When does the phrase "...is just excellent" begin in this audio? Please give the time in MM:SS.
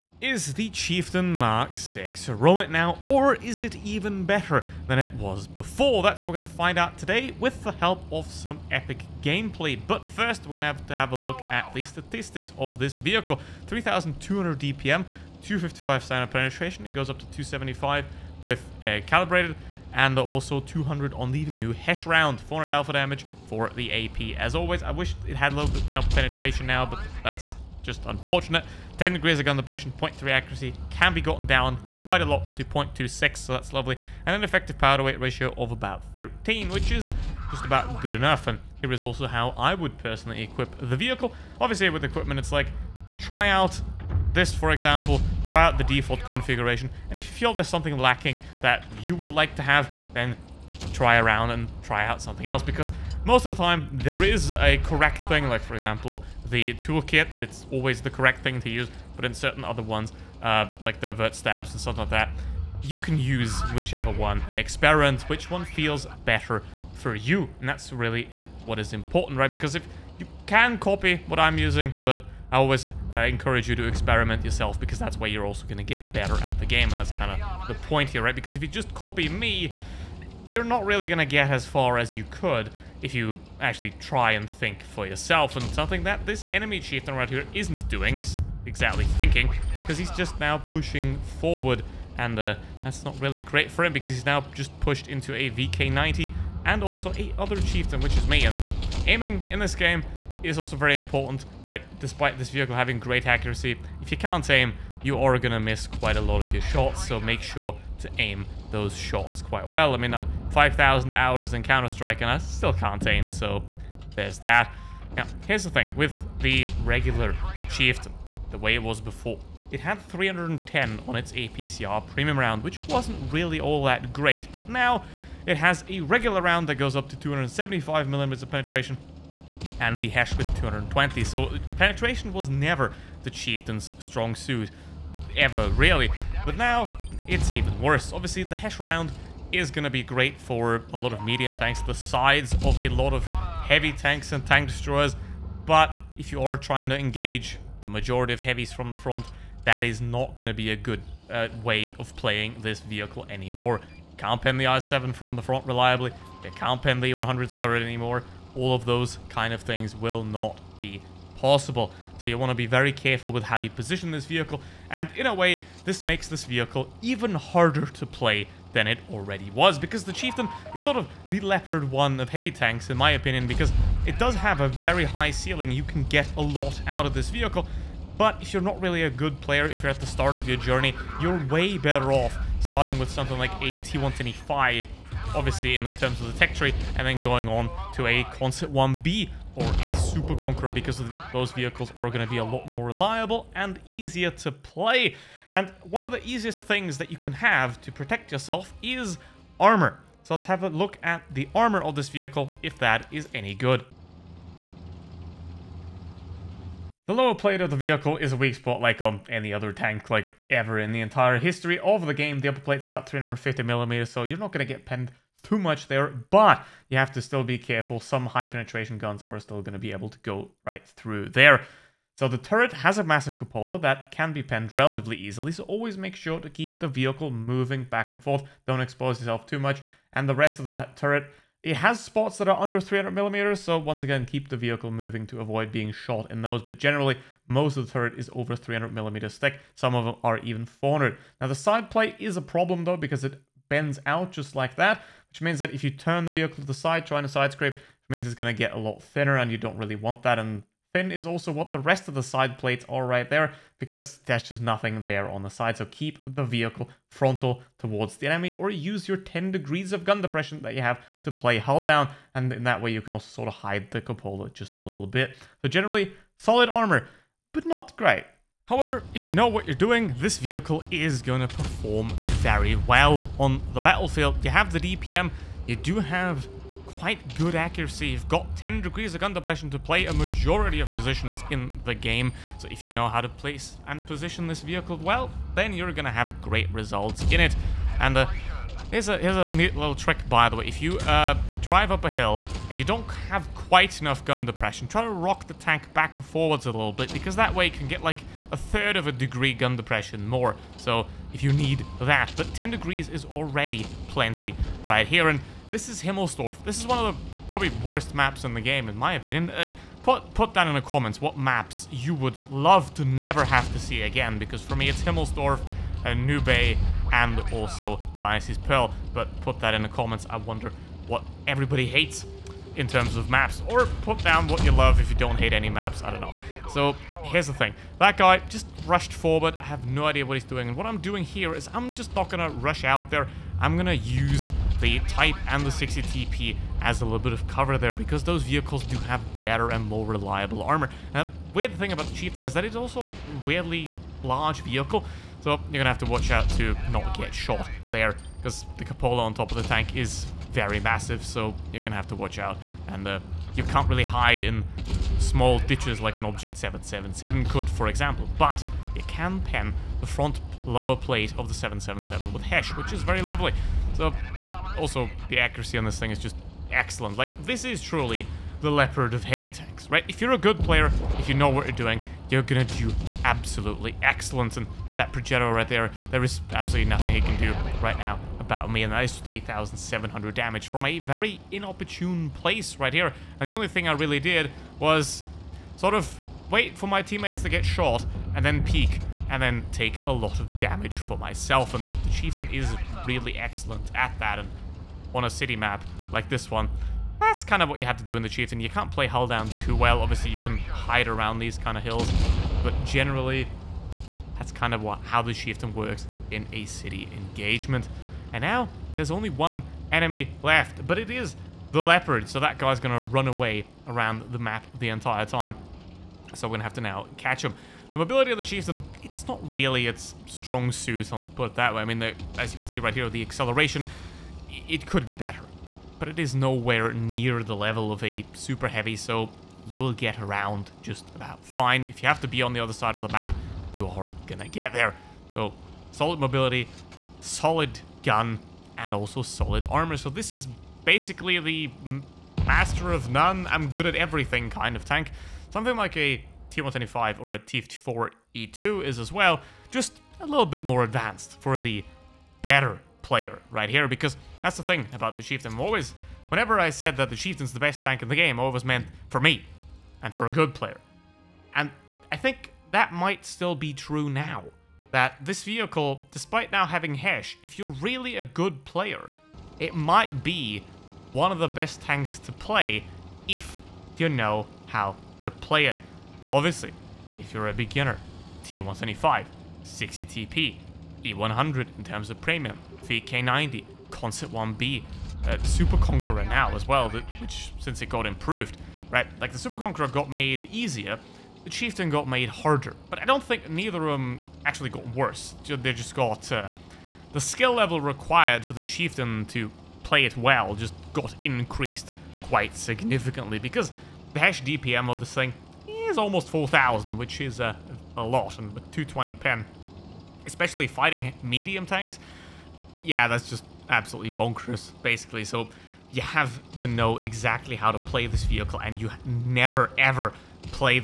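06:06.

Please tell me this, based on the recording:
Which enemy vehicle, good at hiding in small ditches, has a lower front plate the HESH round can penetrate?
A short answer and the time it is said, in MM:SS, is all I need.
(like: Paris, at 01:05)
Object 777, at 05:56.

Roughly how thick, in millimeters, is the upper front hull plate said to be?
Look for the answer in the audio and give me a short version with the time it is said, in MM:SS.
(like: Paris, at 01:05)
350mm, at 03:33.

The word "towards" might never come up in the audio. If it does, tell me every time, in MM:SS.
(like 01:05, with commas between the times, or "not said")
04:17.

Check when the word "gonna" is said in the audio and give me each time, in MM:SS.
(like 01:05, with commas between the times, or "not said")
05:51, 07:14.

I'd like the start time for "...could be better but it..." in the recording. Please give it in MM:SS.
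07:04.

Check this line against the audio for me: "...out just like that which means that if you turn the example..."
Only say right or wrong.
wrong.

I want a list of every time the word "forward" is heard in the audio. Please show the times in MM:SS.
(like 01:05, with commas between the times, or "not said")
01:31, 04:56, 05:29.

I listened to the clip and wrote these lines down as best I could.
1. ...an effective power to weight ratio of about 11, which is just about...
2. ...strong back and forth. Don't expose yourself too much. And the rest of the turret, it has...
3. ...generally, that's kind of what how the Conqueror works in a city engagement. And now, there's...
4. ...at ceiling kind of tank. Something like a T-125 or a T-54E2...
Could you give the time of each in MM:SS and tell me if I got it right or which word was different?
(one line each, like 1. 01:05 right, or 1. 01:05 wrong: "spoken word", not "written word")
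1. 00:34 wrong: "13", not "11"
2. 03:47 wrong: "moving", not "strong"
3. 06:42 wrong: "Chieftain", not "Conqueror"
4. 07:23 wrong: "everything", not "ceiling".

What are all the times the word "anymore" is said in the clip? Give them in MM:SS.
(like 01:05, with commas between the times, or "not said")
02:33, 02:37.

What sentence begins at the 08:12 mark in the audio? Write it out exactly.
But I don't think neither of them actually got worse.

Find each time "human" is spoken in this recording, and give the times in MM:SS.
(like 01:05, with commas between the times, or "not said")
not said.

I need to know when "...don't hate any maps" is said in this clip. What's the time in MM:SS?
05:25.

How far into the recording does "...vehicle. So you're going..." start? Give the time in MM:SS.
05:44.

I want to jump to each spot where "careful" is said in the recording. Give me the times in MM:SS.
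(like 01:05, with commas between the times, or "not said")
02:42, 03:37.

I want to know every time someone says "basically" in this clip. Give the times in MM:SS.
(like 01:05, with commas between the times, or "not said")
07:20, 08:34.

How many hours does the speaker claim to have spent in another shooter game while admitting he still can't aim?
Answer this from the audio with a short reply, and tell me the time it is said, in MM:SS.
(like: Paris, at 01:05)
5,000, at 01:50.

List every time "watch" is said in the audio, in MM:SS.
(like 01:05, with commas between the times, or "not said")
05:46, 05:52.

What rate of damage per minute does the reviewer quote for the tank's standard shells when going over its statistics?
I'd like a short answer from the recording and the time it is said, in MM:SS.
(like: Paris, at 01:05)
3,200, at 00:13.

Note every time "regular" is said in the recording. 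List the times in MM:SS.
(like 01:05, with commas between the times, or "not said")
01:56, 02:06.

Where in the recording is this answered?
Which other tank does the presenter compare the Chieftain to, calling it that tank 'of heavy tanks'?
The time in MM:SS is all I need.
02:51.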